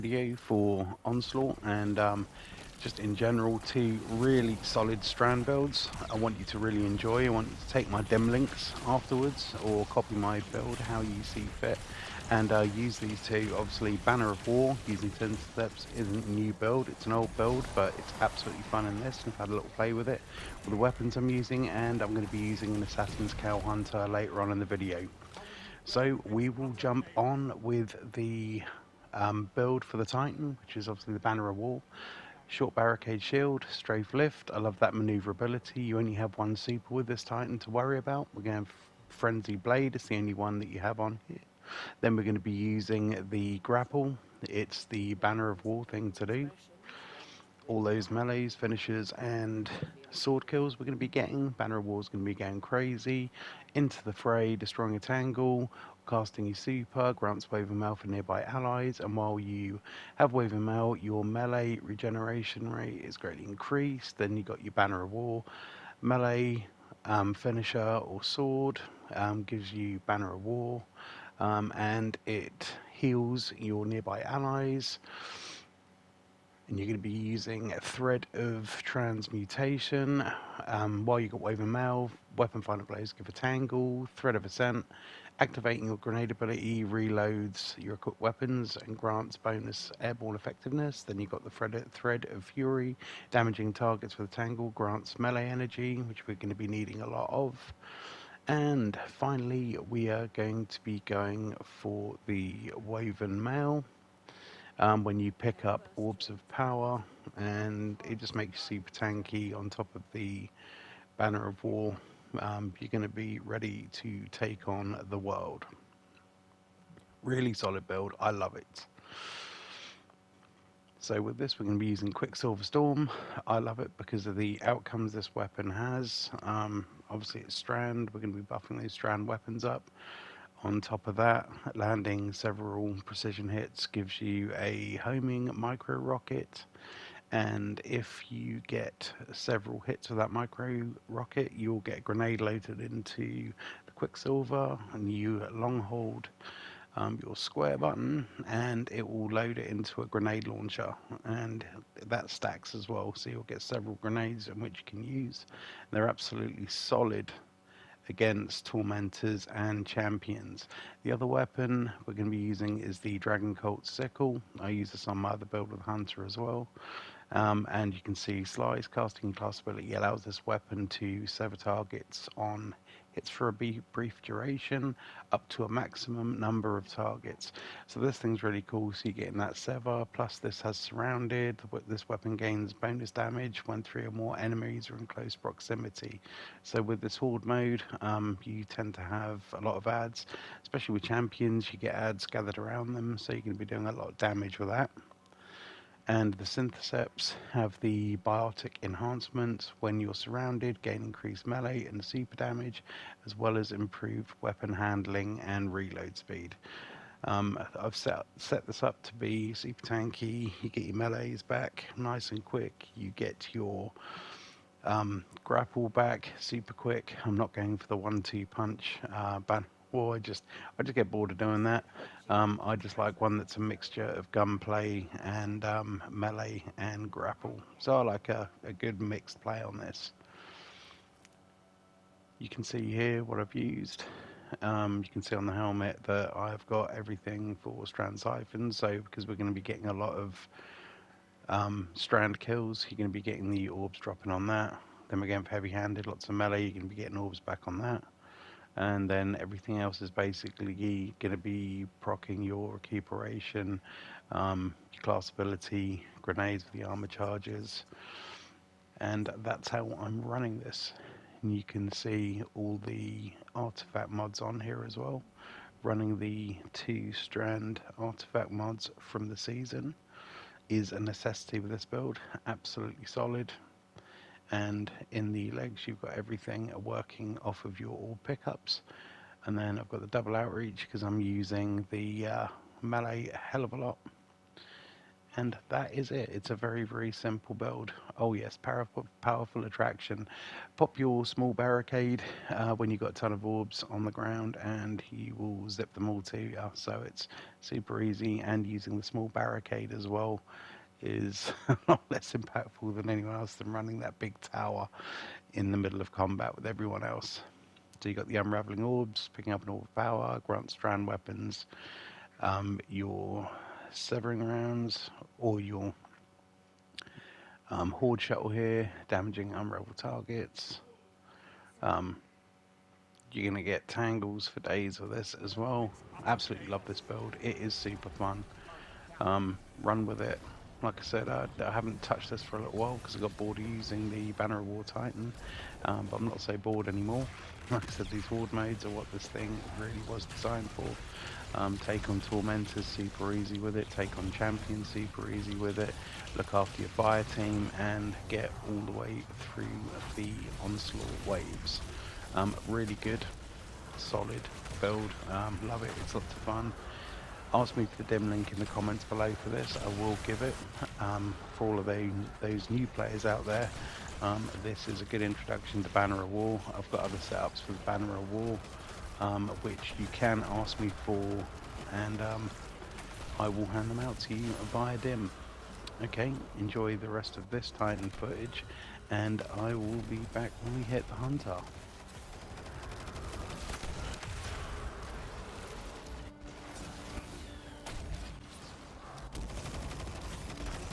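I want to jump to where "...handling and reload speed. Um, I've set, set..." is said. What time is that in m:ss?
3:24.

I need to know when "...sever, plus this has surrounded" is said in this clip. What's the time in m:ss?
2:59.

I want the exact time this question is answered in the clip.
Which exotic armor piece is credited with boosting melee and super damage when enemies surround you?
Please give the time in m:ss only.
3:16.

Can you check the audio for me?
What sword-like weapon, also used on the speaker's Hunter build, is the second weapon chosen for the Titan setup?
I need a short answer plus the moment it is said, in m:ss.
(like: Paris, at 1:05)
Dragon Cult Sickle, at 2:43.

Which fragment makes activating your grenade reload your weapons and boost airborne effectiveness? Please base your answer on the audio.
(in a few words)
Thread of Ascent.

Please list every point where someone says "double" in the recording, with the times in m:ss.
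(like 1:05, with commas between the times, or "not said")
4:40.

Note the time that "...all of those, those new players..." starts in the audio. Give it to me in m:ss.
6:01.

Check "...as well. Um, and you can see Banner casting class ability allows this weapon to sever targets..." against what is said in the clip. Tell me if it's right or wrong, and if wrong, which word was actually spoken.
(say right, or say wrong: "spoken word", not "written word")
wrong: "Slice", not "Banner".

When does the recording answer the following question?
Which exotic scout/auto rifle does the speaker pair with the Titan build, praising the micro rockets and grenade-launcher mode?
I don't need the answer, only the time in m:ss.
2:02.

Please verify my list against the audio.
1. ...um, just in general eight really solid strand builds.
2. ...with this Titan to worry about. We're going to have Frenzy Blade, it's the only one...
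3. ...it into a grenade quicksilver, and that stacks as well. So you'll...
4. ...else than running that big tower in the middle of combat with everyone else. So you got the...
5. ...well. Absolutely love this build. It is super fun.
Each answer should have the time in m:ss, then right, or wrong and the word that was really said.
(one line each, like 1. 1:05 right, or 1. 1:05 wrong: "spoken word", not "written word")
1. 0:01 wrong: "two", not "eight"
2. 0:36 right
3. 2:29 wrong: "launcher", not "quicksilver"
4. 5:03 right
5. 5:25 right.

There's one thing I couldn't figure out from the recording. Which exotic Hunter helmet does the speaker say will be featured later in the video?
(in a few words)
Assassin's Cowl.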